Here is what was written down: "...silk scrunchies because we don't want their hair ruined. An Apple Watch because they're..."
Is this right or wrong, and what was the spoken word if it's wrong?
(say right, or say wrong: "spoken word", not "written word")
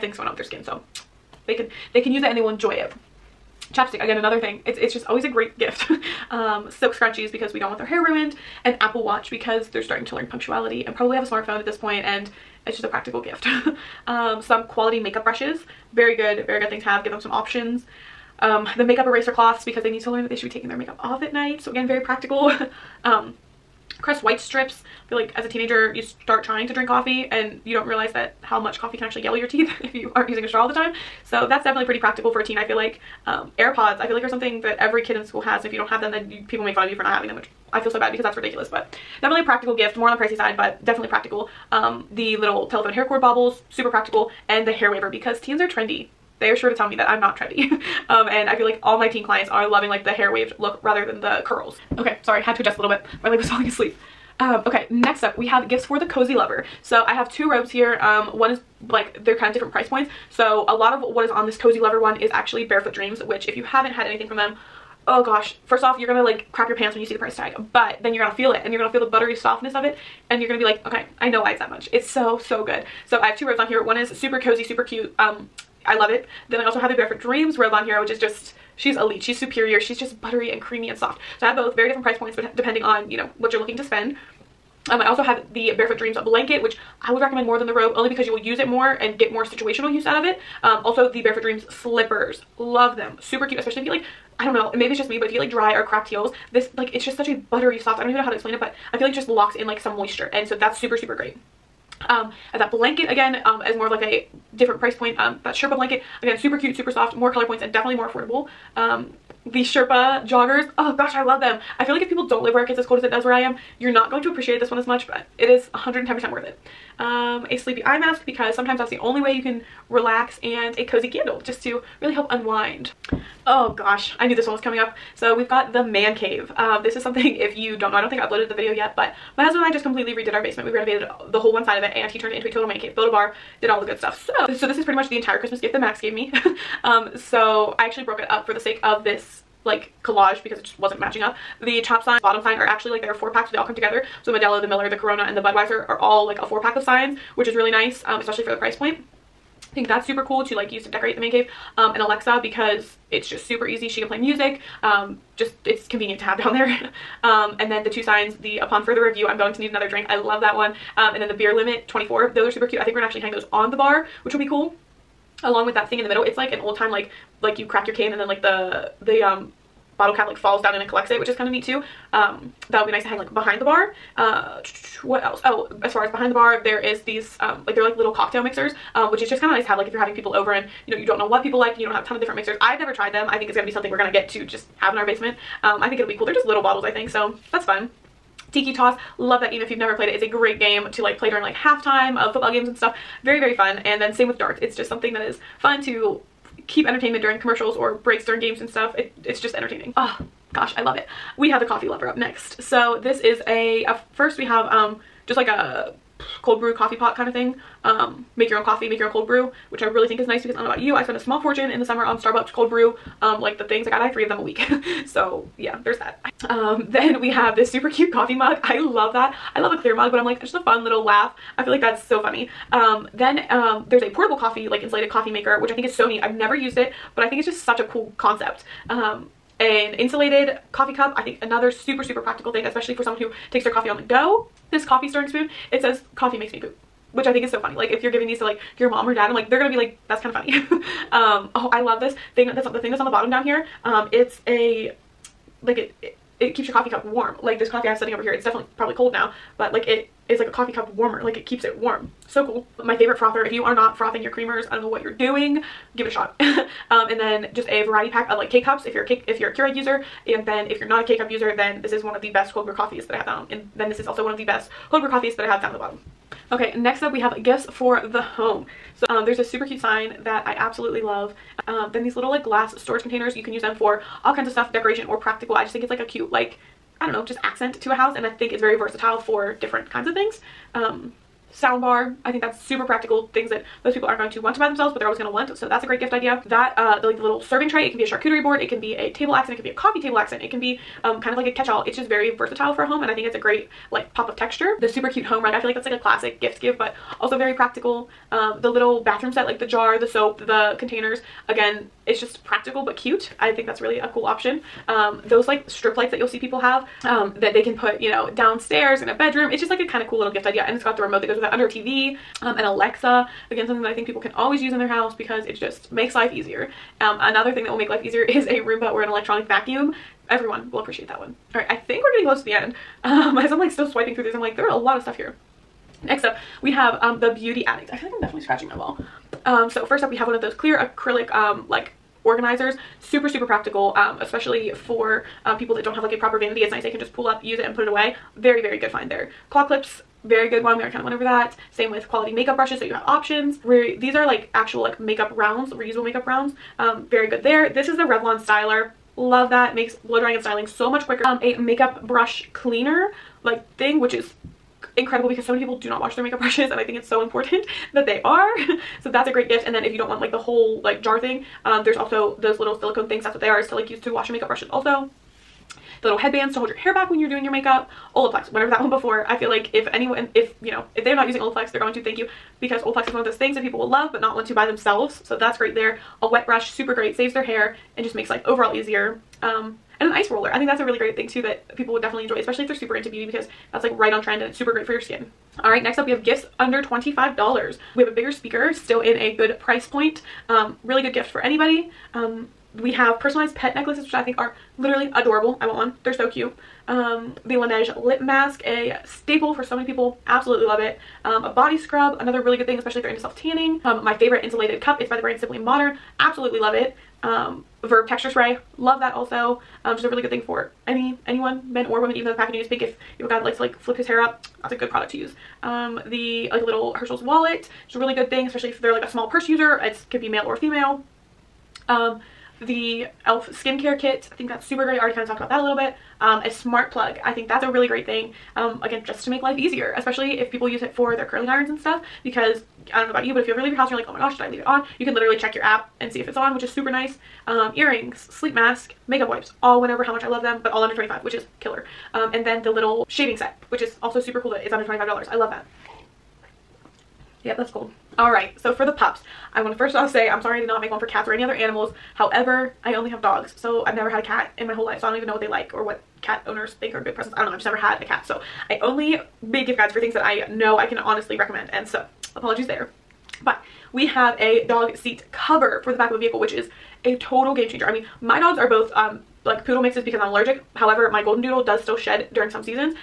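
right.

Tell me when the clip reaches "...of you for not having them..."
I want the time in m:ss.
0:36.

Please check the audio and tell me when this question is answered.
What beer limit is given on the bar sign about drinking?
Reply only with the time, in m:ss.
2:41.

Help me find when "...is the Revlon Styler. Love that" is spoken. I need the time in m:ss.
5:47.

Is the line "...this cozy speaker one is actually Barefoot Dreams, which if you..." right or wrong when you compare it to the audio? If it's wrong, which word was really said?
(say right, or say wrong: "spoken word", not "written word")
wrong: "lover", not "speaker".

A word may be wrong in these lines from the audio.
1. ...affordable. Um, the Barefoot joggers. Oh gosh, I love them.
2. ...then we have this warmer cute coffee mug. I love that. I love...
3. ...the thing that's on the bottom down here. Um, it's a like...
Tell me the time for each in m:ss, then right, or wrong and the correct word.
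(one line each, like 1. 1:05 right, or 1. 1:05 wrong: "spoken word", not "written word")
1. 1:48 wrong: "Sherpa", not "Barefoot"
2. 3:36 wrong: "super", not "warmer"
3. 4:02 right.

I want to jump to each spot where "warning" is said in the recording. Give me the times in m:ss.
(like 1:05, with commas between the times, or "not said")
not said.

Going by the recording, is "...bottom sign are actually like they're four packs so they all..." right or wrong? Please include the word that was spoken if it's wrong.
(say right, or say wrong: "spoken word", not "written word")
right.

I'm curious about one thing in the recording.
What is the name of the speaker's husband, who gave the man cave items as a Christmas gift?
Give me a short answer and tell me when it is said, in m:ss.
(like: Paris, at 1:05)
Max, at 2:15.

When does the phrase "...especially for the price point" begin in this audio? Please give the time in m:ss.
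2:28.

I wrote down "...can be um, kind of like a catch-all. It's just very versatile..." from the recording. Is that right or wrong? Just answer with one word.
right.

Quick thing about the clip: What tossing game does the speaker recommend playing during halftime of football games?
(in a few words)
Tiki Toss.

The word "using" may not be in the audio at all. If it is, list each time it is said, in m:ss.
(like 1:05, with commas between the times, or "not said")
0:30, 6:11.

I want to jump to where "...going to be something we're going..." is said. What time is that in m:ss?
3:03.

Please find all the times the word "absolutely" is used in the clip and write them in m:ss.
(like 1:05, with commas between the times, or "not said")
4:30, 6:40, 6:46.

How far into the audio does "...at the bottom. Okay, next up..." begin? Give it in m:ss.
4:25.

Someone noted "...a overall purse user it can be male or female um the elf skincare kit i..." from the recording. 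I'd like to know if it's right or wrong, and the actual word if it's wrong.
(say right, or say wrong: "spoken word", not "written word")
wrong: "small", not "overall".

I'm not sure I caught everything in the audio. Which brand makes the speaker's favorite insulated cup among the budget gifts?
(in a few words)
Simply Modern.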